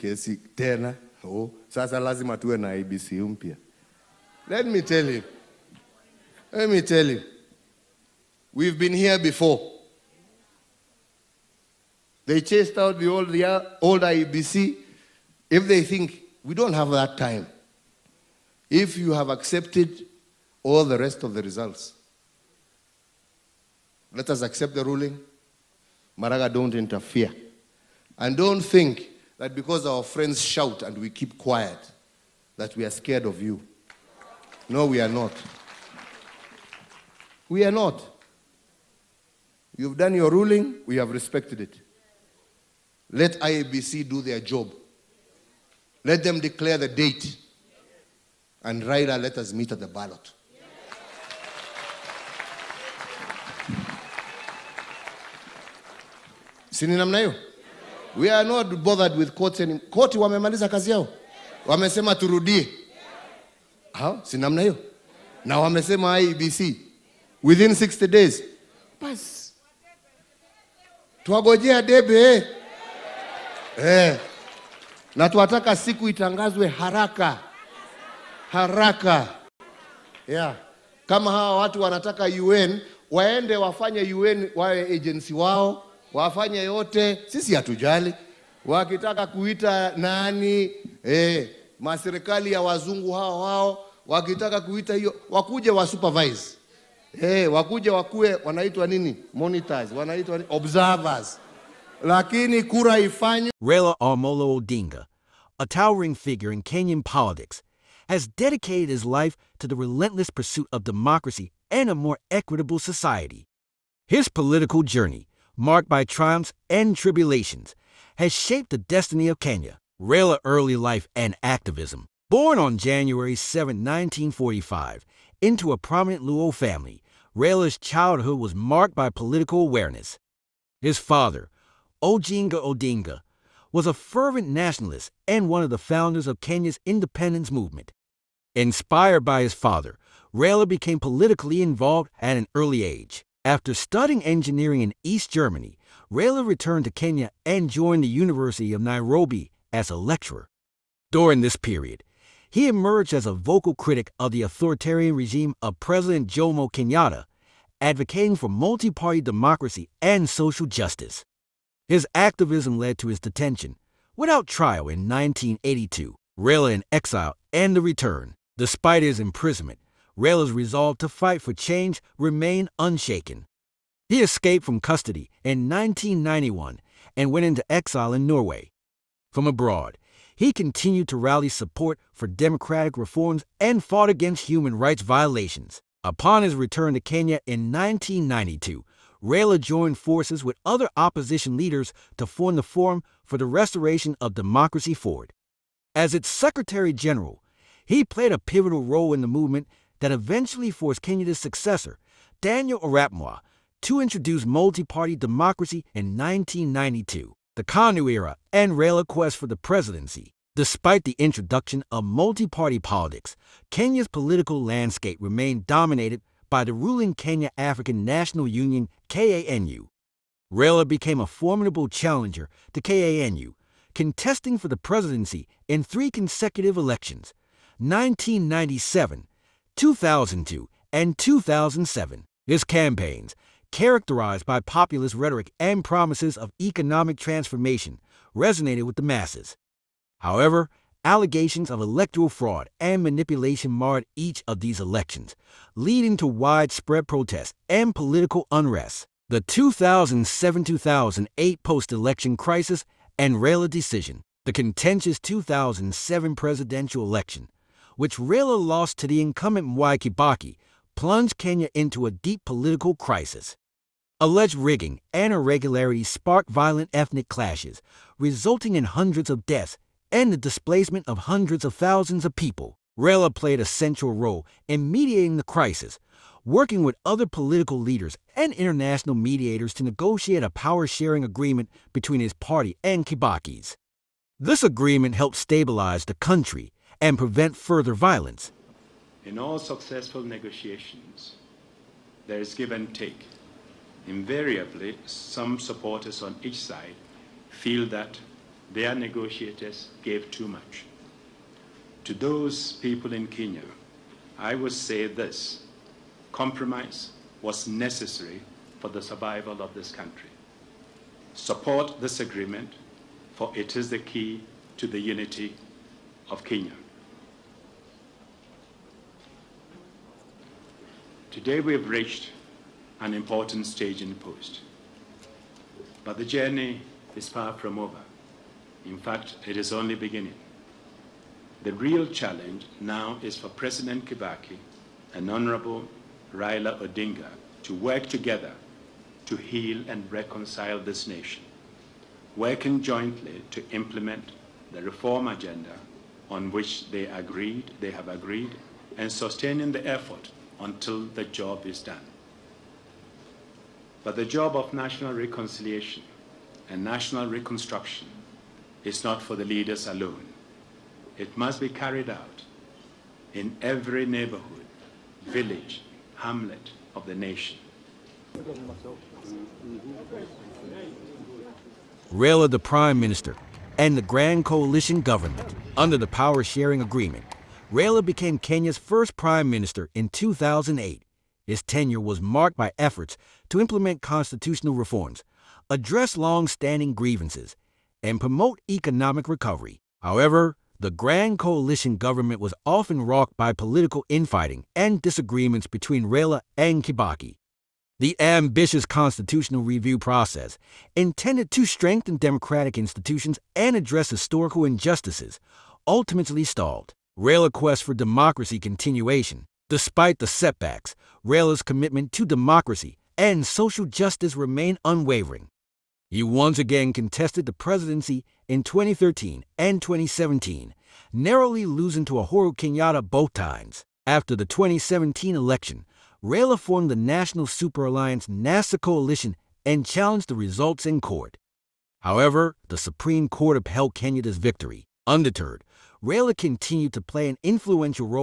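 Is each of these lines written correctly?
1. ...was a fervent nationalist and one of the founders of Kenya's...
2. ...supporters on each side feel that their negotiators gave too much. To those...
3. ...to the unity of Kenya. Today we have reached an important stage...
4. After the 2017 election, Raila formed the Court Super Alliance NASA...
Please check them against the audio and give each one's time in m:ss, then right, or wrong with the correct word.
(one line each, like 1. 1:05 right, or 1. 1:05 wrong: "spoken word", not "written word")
1. 2:13 right
2. 4:55 right
3. 5:14 right
4. 7:04 wrong: "National", not "Court".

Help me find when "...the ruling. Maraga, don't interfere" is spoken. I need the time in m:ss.
0:24.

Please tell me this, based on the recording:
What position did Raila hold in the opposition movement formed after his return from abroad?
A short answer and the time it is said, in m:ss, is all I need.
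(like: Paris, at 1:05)
Secretary General, at 3:16.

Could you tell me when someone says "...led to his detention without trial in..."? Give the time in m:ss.
2:42.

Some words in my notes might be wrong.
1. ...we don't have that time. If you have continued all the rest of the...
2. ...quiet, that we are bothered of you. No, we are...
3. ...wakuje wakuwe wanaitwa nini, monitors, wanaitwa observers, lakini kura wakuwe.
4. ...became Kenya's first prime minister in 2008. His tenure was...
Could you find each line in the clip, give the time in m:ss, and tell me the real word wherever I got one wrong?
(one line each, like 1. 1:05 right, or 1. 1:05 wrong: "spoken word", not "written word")
1. 0:16 wrong: "accepted", not "continued"
2. 0:31 wrong: "scared", not "bothered"
3. 1:37 wrong: "ifanywe", not "wakuwe"
4. 6:18 right.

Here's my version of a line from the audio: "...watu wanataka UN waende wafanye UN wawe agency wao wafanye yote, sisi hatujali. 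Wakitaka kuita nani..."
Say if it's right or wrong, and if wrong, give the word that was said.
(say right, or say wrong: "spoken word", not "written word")
right.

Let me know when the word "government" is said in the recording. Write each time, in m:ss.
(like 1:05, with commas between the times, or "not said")
6:15, 6:31.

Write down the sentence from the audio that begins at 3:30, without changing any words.
Despite the introduction of multi-party politics, Kenya's political landscape remained dominated by the ruling Kenya African National Union, KANU.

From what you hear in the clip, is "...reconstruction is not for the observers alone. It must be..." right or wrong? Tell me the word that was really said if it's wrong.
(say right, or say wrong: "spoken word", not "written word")
wrong: "leaders", not "observers".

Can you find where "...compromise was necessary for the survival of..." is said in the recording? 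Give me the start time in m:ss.
5:06.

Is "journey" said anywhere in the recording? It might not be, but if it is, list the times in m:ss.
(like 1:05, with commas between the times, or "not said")
1:54, 5:26.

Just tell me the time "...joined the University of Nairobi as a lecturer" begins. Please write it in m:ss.
2:27.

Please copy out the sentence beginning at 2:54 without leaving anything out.
He escaped from custody in 1991 and went into exile in Norway.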